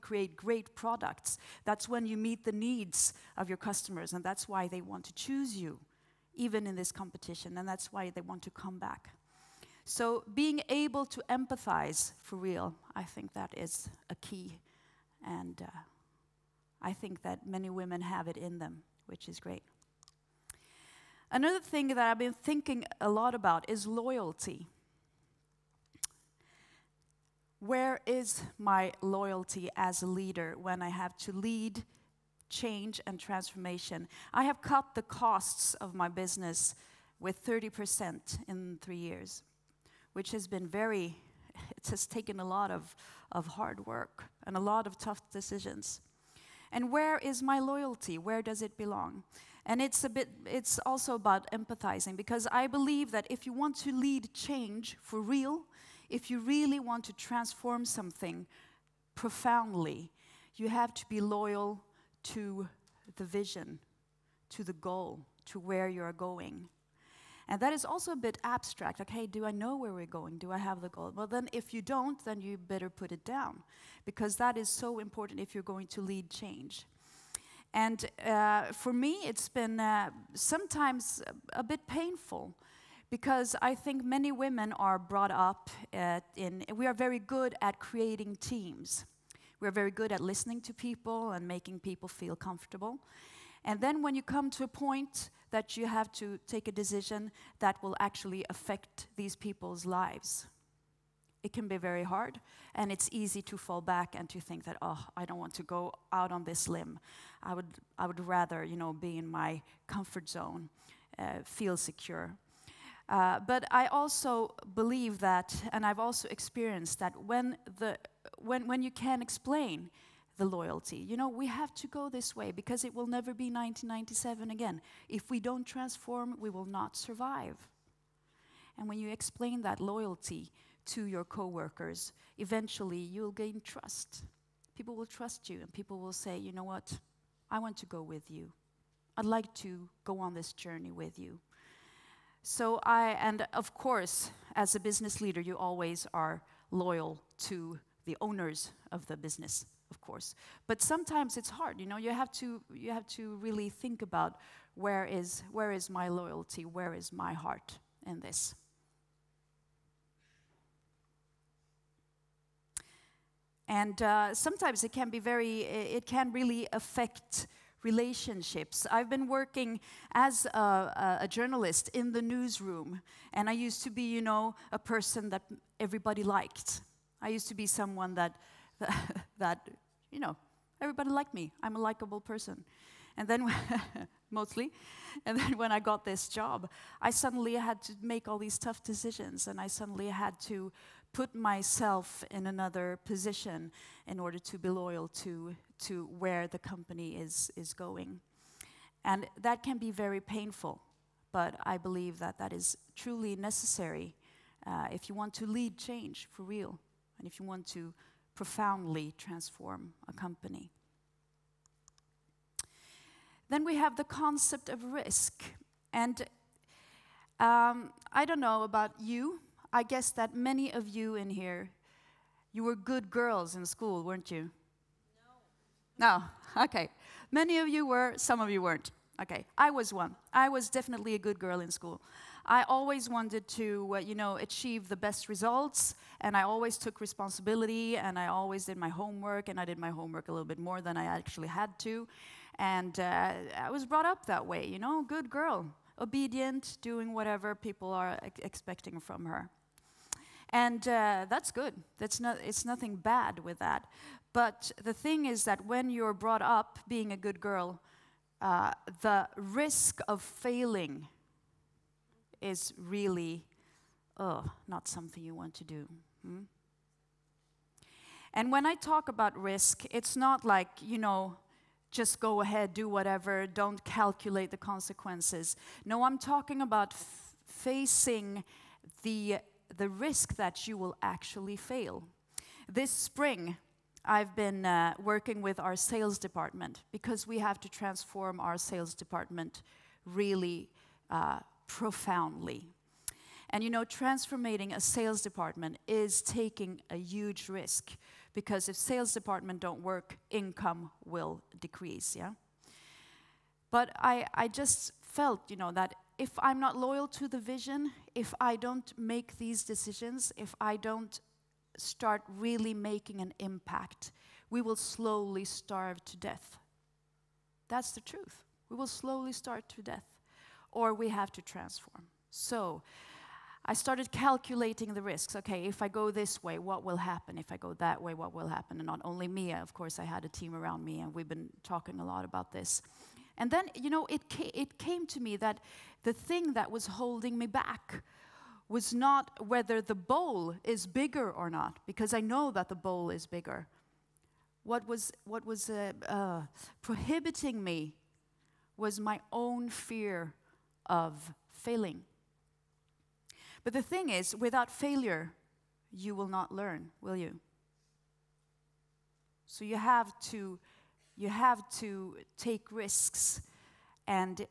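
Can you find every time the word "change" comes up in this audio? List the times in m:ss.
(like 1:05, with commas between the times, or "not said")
0:32, 0:54, 1:16, 3:25.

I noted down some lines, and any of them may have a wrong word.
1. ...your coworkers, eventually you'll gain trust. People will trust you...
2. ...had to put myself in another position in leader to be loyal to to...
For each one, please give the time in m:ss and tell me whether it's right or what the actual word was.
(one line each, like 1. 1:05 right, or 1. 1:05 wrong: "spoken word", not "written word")
1. 2:11 right
2. 3:10 wrong: "order", not "leader".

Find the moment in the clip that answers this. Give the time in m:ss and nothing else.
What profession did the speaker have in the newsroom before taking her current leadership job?
2:51.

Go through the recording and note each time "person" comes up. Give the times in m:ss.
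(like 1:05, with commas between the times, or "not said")
2:54, 3:02.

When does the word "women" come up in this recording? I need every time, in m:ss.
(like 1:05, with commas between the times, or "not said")
0:17, 1:24.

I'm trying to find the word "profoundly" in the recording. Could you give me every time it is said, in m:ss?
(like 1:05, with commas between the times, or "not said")
0:59, 3:28, 4:51.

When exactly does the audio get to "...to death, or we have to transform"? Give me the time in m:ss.
5:19.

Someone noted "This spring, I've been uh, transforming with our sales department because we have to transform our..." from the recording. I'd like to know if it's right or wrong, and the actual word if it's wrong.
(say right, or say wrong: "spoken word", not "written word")
wrong: "working", not "transforming".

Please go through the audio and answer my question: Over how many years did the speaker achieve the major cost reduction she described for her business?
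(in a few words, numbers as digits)
3.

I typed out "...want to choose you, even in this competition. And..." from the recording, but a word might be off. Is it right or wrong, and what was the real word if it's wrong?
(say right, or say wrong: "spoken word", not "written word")
right.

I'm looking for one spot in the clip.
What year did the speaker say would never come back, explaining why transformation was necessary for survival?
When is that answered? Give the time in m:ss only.
2:03.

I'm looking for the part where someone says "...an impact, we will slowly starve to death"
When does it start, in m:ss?
5:13.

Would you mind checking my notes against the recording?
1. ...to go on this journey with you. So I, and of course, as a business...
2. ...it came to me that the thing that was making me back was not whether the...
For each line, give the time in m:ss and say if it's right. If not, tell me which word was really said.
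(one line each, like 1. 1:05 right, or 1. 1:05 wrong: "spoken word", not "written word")
1. 2:19 right
2. 5:34 wrong: "holding", not "making".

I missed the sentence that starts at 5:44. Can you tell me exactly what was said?
What was, what was uh, uh, prohibiting me was my own fear of failing.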